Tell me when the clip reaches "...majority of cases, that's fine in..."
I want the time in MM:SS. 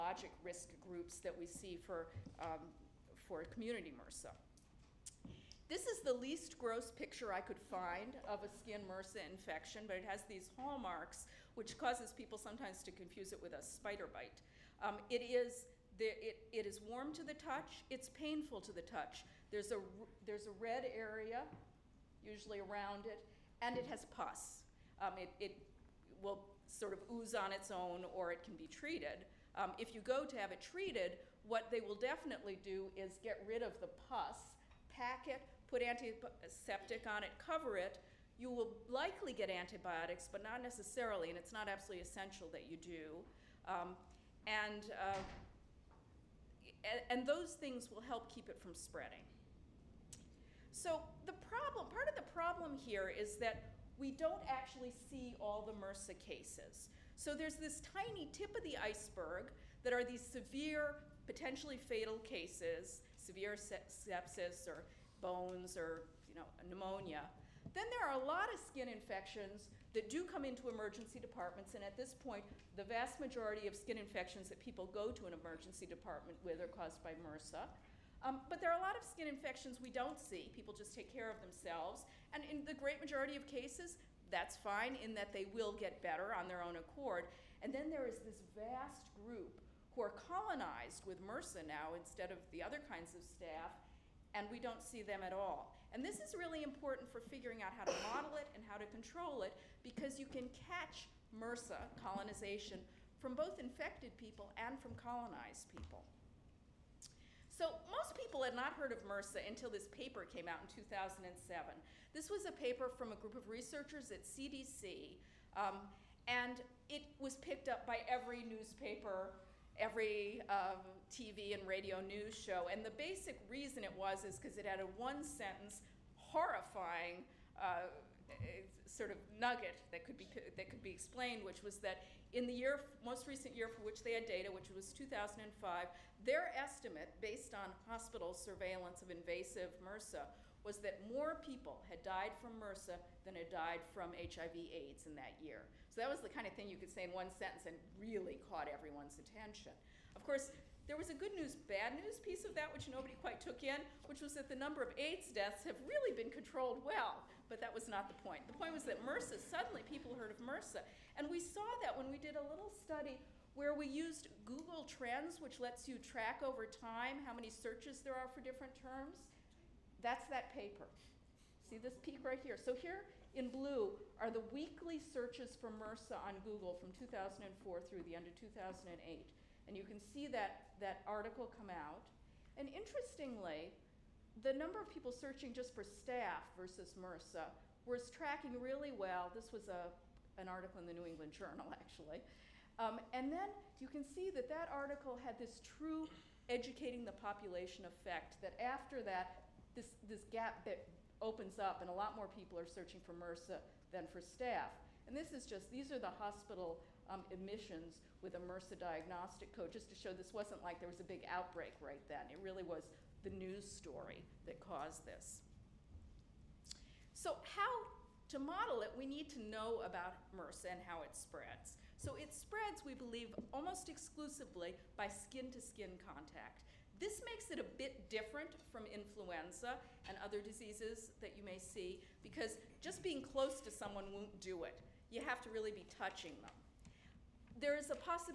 01:22.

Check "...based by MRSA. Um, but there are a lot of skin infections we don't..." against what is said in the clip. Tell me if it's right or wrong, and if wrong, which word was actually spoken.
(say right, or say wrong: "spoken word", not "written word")
wrong: "caused", not "based".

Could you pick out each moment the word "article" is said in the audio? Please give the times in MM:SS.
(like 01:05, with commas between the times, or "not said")
03:01, 03:10, 03:14.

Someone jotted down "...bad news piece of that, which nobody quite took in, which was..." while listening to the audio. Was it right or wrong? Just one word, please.
right.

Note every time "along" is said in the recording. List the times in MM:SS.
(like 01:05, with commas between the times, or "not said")
not said.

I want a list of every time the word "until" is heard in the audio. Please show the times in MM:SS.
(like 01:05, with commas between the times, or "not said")
01:49.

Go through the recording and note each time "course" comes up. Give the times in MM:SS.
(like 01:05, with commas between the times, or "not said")
02:30.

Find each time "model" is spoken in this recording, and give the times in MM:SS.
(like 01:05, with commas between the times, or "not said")
01:38, 03:38.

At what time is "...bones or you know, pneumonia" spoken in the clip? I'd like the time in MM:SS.
01:05.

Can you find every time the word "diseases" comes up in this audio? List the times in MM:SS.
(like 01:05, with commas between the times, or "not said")
03:50.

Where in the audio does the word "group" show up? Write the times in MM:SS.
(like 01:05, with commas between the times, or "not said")
00:00, 01:29, 01:53.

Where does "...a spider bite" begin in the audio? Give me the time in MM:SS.
00:13.